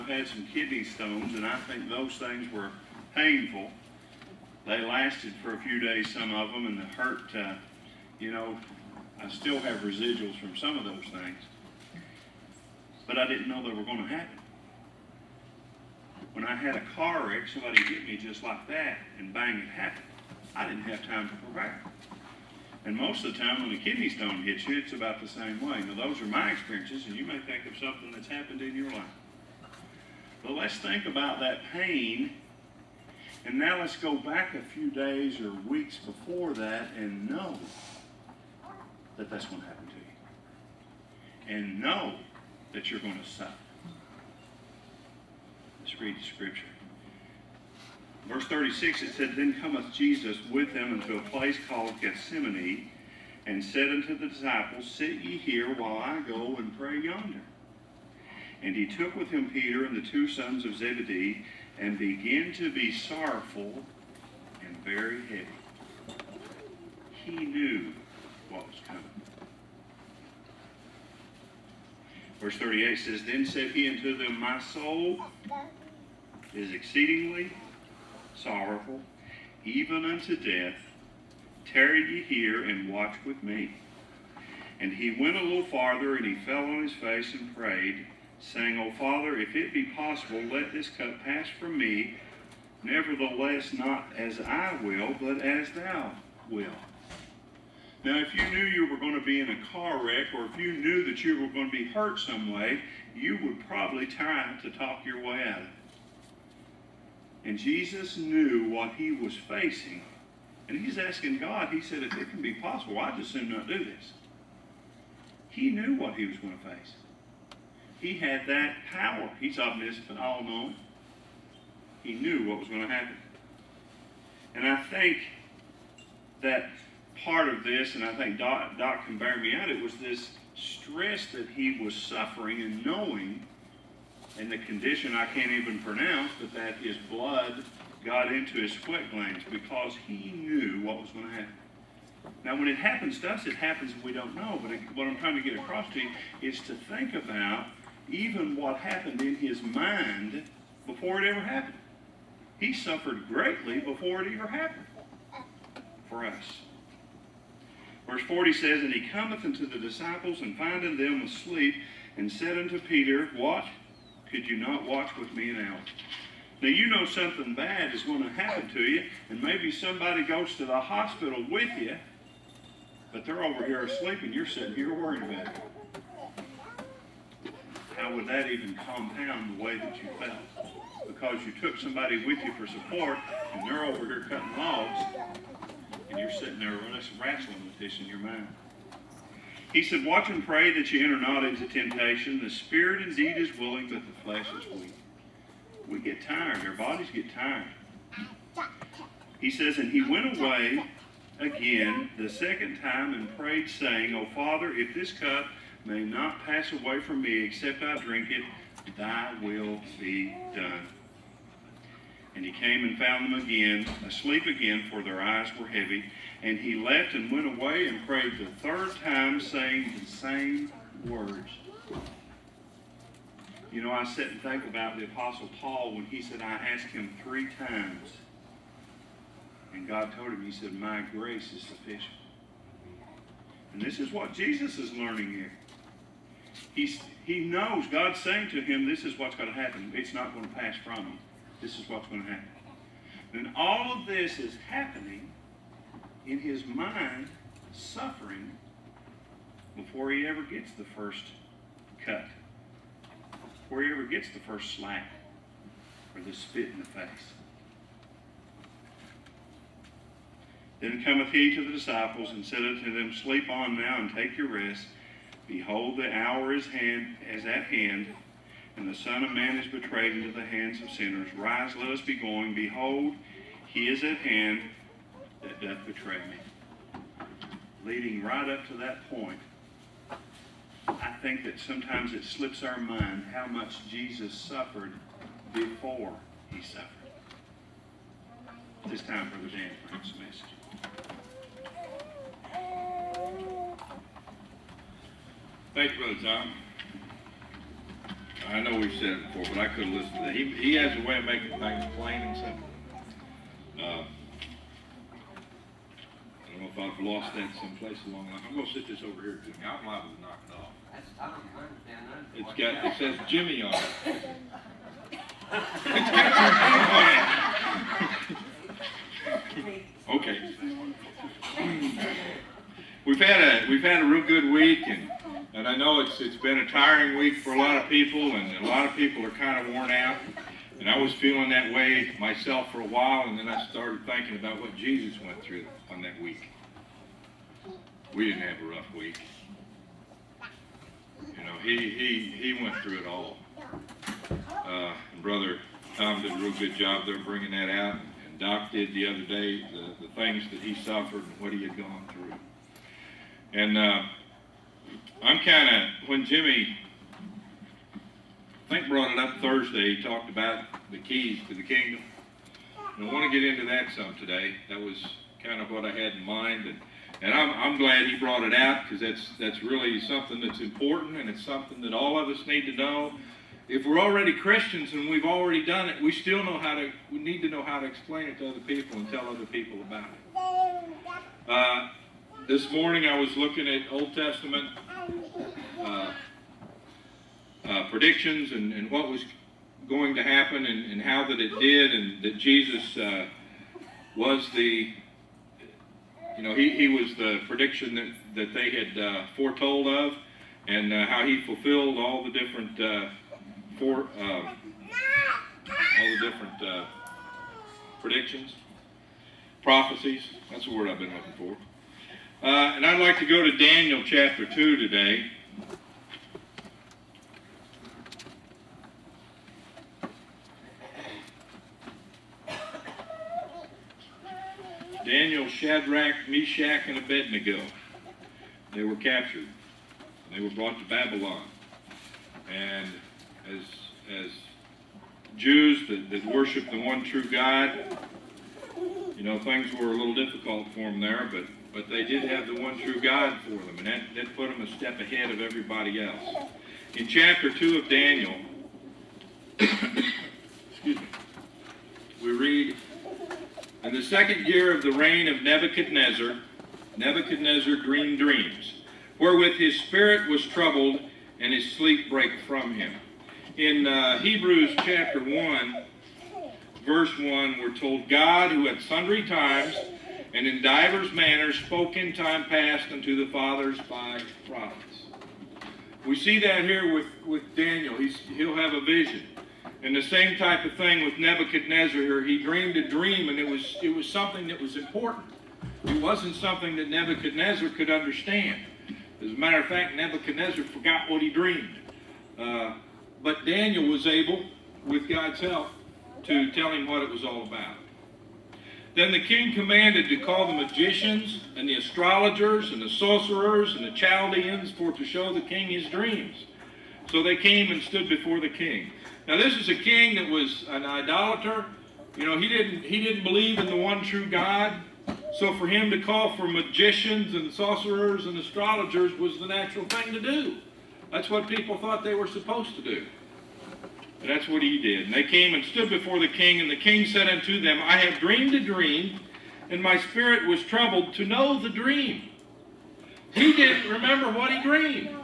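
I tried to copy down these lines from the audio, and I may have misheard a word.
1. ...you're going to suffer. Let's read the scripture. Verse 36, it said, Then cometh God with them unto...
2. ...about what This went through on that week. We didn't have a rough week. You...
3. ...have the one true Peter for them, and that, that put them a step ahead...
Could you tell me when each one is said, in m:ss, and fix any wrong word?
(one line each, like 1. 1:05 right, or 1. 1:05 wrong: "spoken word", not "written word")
1. 0:42 wrong: "Jesus", not "God"
2. 5:34 wrong: "Jesus", not "This"
3. 7:22 wrong: "God", not "Peter".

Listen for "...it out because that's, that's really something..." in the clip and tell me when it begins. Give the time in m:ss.
6:08.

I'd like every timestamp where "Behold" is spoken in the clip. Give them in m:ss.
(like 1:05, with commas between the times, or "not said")
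4:25, 4:32.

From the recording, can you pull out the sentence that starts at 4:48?
It's time for the Dan Frank's message.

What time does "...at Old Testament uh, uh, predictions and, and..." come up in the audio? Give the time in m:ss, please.
6:23.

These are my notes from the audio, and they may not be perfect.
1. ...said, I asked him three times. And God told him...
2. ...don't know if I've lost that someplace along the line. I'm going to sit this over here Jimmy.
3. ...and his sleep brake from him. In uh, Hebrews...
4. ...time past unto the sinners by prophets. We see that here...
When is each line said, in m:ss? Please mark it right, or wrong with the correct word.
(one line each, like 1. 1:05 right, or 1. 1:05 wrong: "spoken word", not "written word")
1. 3:46 right
2. 5:06 right
3. 7:41 right
4. 7:52 wrong: "fathers", not "sinners".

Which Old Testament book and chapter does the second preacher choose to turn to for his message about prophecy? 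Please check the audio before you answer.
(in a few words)
Daniel chapter 2.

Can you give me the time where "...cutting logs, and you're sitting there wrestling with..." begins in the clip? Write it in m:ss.
3:04.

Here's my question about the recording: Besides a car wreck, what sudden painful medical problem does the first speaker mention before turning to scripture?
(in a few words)
Kidney stones.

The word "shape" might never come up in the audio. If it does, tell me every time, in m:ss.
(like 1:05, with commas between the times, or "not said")
not said.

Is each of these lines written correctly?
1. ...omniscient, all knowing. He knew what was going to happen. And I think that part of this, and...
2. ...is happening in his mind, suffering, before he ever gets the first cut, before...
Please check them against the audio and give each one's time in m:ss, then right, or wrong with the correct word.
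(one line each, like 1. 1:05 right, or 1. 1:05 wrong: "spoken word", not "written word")
1. 1:59 right
2. 4:04 right.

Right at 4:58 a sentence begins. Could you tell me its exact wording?
I know we've said it before, but I couldn't listen to that.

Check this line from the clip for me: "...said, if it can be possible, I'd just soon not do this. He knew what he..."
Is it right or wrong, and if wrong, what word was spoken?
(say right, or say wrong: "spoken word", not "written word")
right.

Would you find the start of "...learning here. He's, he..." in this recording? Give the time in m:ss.
3:54.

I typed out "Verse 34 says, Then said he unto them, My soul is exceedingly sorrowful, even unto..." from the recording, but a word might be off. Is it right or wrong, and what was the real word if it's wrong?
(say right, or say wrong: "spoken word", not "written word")
wrong: "38", not "34".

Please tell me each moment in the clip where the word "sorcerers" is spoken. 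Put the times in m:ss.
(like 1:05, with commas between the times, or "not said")
8:22, 8:37.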